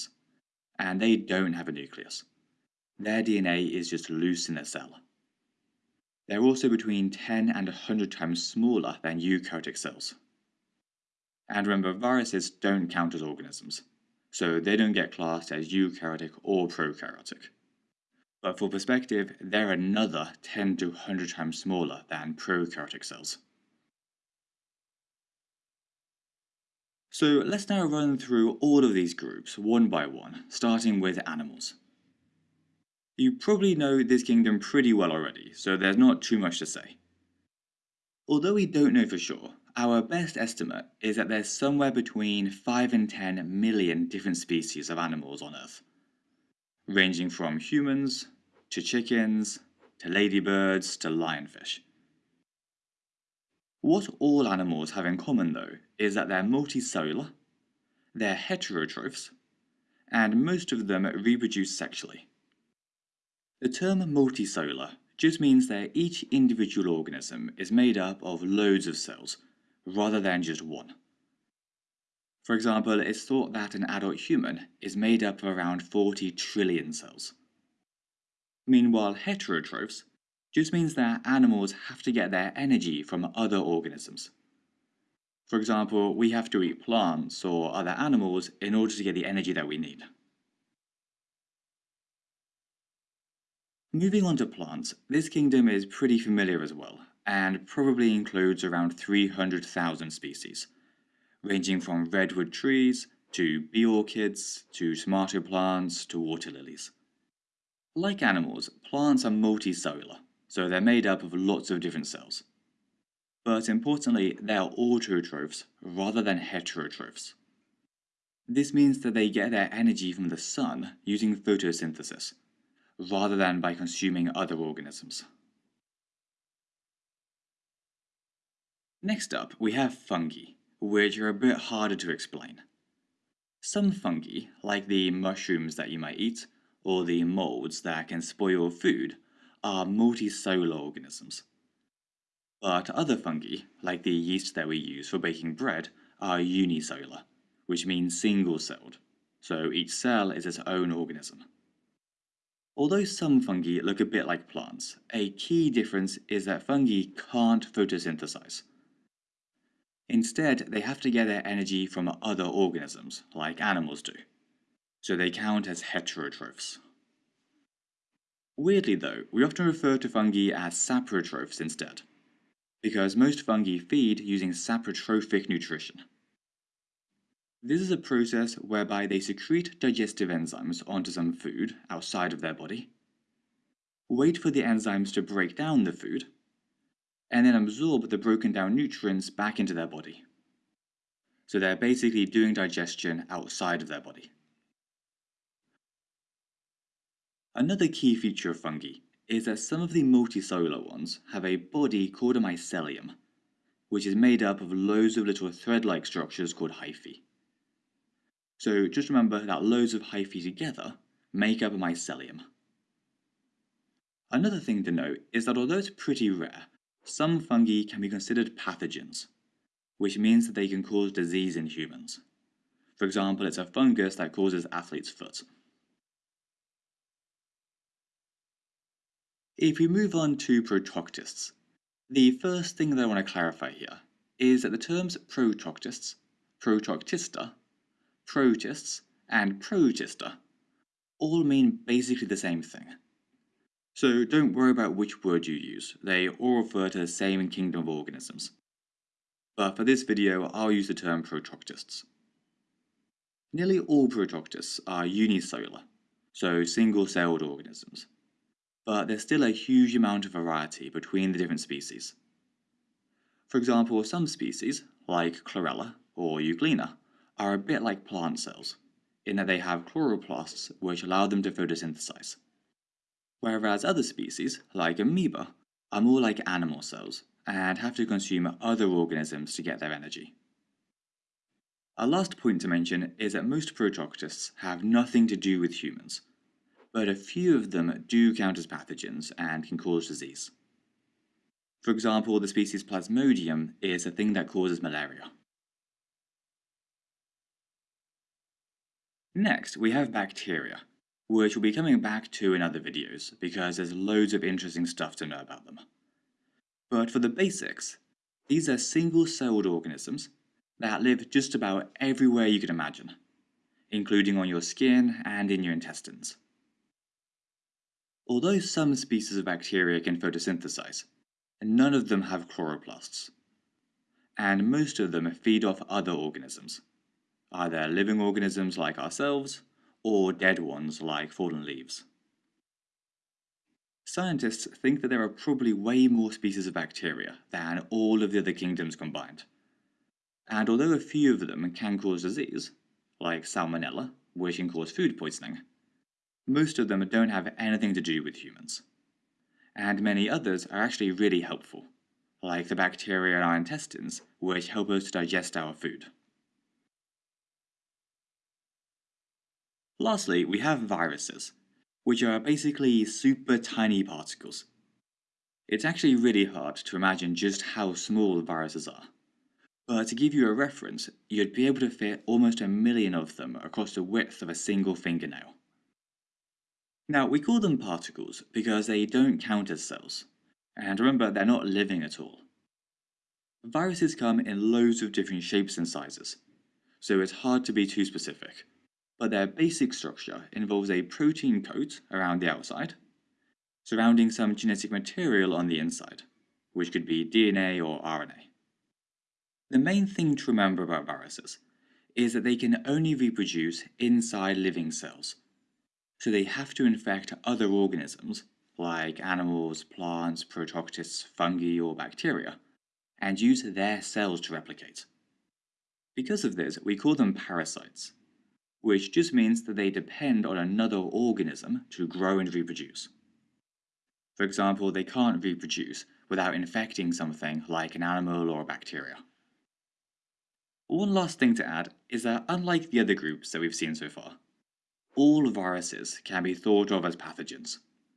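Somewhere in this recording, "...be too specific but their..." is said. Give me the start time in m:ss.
6:27.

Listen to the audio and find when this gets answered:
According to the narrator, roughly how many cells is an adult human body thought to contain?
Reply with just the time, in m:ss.
1:15.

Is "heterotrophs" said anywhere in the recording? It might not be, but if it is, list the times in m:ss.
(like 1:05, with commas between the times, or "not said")
0:58, 1:19, 1:56, 2:45.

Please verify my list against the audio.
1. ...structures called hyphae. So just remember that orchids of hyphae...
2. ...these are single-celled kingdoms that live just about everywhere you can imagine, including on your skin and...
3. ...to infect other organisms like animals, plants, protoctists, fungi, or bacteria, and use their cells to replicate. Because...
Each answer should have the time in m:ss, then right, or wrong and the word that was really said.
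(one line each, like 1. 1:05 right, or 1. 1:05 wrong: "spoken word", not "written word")
1. 3:26 wrong: "loads", not "orchids"
2. 5:08 wrong: "organisms", not "kingdoms"
3. 6:46 right.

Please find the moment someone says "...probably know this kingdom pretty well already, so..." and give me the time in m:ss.
0:33.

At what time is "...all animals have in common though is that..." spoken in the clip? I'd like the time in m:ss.
0:54.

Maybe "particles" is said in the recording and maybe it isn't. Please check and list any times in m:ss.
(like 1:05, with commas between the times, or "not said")
6:04, 6:17.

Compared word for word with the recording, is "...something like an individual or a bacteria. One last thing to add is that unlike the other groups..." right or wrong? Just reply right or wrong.
wrong.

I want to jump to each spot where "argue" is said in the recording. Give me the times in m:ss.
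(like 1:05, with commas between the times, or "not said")
not said.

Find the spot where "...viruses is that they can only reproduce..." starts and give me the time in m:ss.
6:41.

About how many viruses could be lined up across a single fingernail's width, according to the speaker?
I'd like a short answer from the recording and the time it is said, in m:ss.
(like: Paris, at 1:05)
almost a million, at 6:12.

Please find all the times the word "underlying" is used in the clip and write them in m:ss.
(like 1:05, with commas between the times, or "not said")
not said.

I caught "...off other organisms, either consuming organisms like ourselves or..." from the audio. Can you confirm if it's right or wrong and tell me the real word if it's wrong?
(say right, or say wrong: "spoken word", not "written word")
wrong: "living", not "consuming".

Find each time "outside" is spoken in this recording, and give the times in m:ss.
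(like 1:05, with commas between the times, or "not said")
3:01, 3:13, 6:32.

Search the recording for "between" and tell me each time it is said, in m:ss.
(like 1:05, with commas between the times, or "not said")
0:06, 0:41, 4:20.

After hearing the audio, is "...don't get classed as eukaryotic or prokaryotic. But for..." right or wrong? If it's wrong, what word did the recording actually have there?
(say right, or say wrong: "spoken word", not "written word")
right.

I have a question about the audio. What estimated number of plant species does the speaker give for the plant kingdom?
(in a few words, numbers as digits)
300,000.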